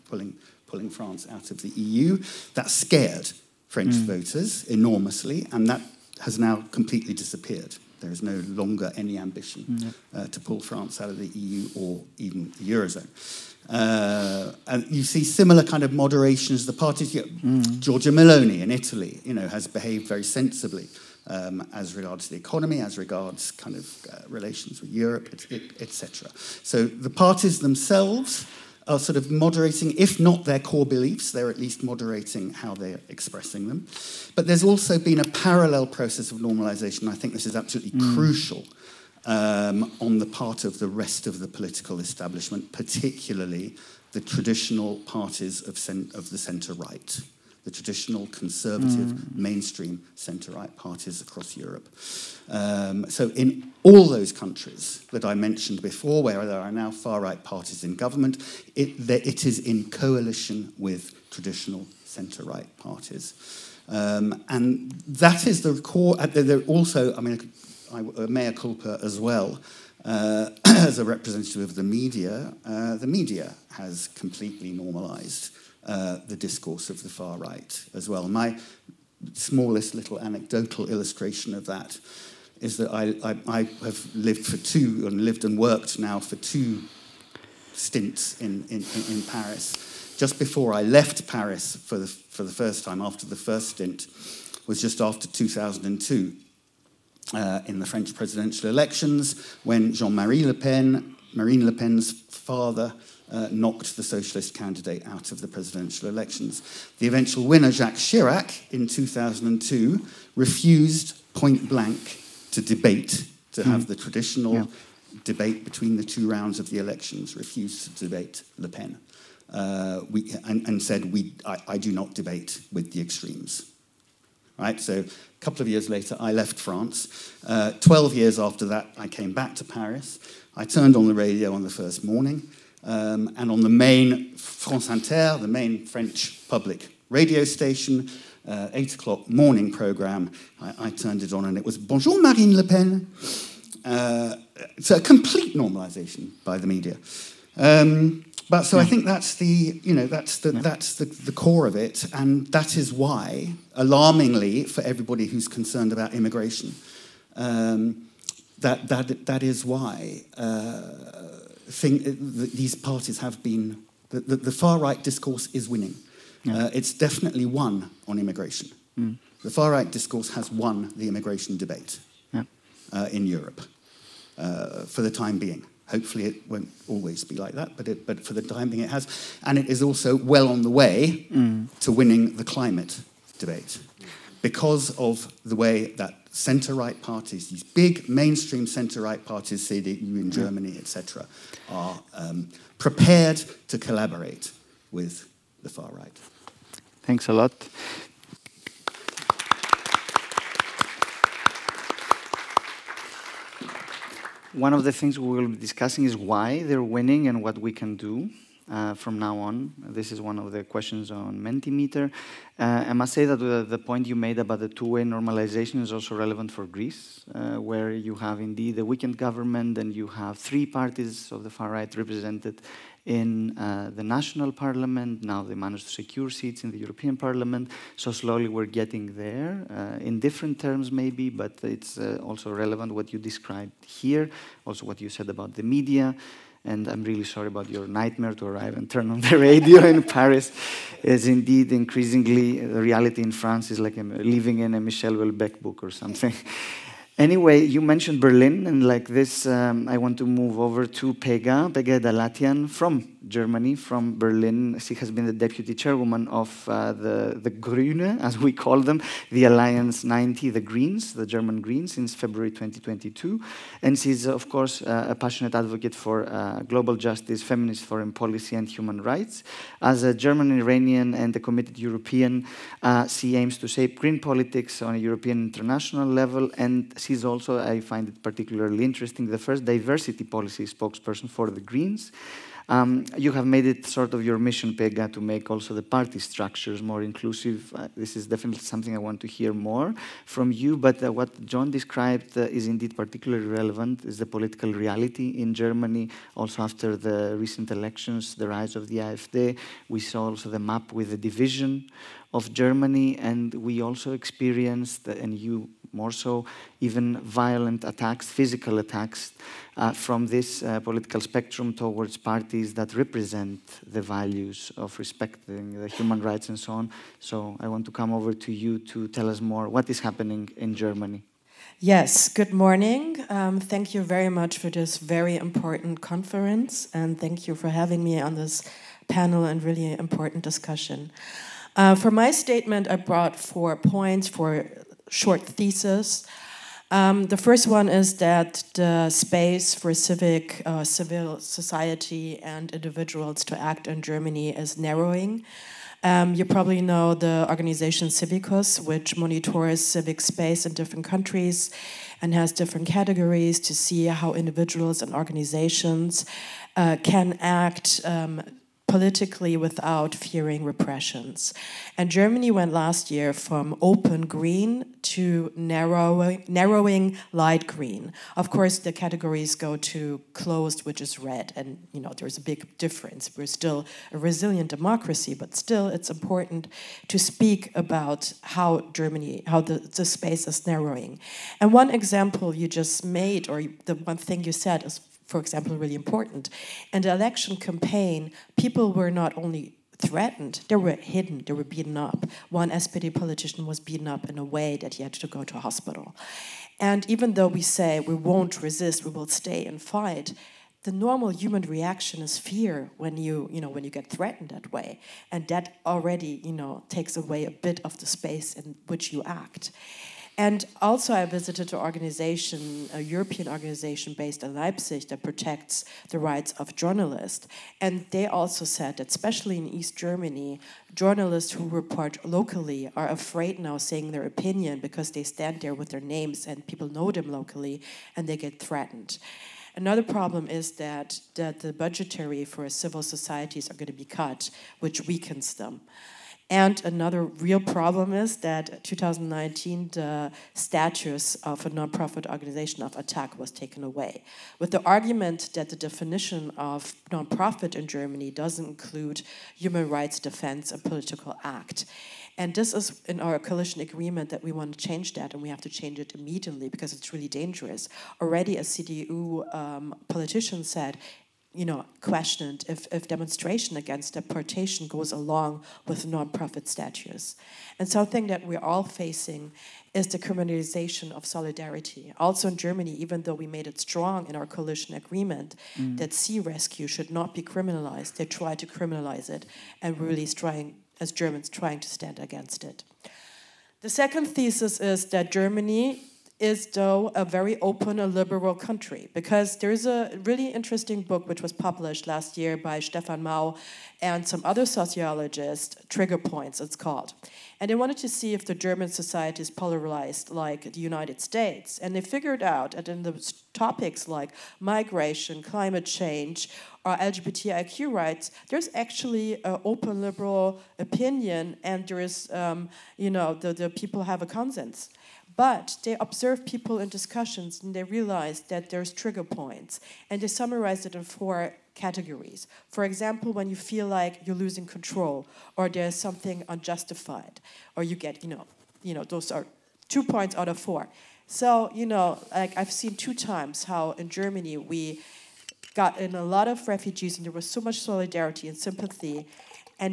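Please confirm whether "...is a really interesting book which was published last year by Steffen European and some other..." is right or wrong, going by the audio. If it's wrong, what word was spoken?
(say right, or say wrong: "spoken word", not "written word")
wrong: "Mau", not "European".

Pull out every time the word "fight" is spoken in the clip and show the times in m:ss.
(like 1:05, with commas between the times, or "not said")
6:39.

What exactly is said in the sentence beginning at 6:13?
We're still a resilient democracy, but still it's important to speak about how Germany, how the, the space is narrowing.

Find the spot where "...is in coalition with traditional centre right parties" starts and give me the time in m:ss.
0:59.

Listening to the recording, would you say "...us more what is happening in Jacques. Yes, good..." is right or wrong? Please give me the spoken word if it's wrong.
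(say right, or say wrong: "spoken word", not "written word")
wrong: "Germany", not "Jacques".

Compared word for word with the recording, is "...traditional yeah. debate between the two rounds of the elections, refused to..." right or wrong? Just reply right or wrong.
right.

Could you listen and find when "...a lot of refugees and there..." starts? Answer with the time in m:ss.
8:56.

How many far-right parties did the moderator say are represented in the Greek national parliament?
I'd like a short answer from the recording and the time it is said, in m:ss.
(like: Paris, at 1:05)
3, at 3:40.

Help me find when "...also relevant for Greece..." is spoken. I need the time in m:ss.
3:35.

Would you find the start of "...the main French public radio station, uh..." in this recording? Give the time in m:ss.
2:15.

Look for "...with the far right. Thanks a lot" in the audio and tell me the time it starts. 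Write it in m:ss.
3:14.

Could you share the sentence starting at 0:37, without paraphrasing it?
I think this is absolutely mm.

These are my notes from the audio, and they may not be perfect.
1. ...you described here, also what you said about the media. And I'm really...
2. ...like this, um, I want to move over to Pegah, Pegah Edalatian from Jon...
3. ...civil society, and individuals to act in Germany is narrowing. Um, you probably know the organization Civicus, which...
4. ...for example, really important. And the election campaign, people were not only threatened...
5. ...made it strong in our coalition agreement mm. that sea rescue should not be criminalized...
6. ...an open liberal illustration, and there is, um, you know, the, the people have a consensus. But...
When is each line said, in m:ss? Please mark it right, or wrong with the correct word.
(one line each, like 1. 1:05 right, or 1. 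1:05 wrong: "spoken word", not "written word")
1. 3:53 right
2. 4:08 wrong: "Germany", not "Jon"
3. 5:40 right
4. 6:25 right
5. 7:53 right
6. 8:29 wrong: "opinion", not "illustration".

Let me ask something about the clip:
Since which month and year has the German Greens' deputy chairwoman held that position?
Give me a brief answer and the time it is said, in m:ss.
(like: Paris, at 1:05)
February 2022, at 4:22.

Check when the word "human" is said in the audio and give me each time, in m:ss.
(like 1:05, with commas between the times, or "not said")
4:28, 5:15, 6:41, 7:29.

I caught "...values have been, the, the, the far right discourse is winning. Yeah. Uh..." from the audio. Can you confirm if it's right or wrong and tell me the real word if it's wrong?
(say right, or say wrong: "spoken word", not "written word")
wrong: "parties", not "values".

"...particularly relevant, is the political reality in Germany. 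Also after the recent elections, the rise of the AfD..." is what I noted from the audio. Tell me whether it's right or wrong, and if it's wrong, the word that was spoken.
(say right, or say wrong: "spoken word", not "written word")
right.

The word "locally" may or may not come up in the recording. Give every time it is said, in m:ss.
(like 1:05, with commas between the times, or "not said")
7:02, 7:07.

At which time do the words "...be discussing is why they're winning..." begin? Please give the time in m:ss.
3:25.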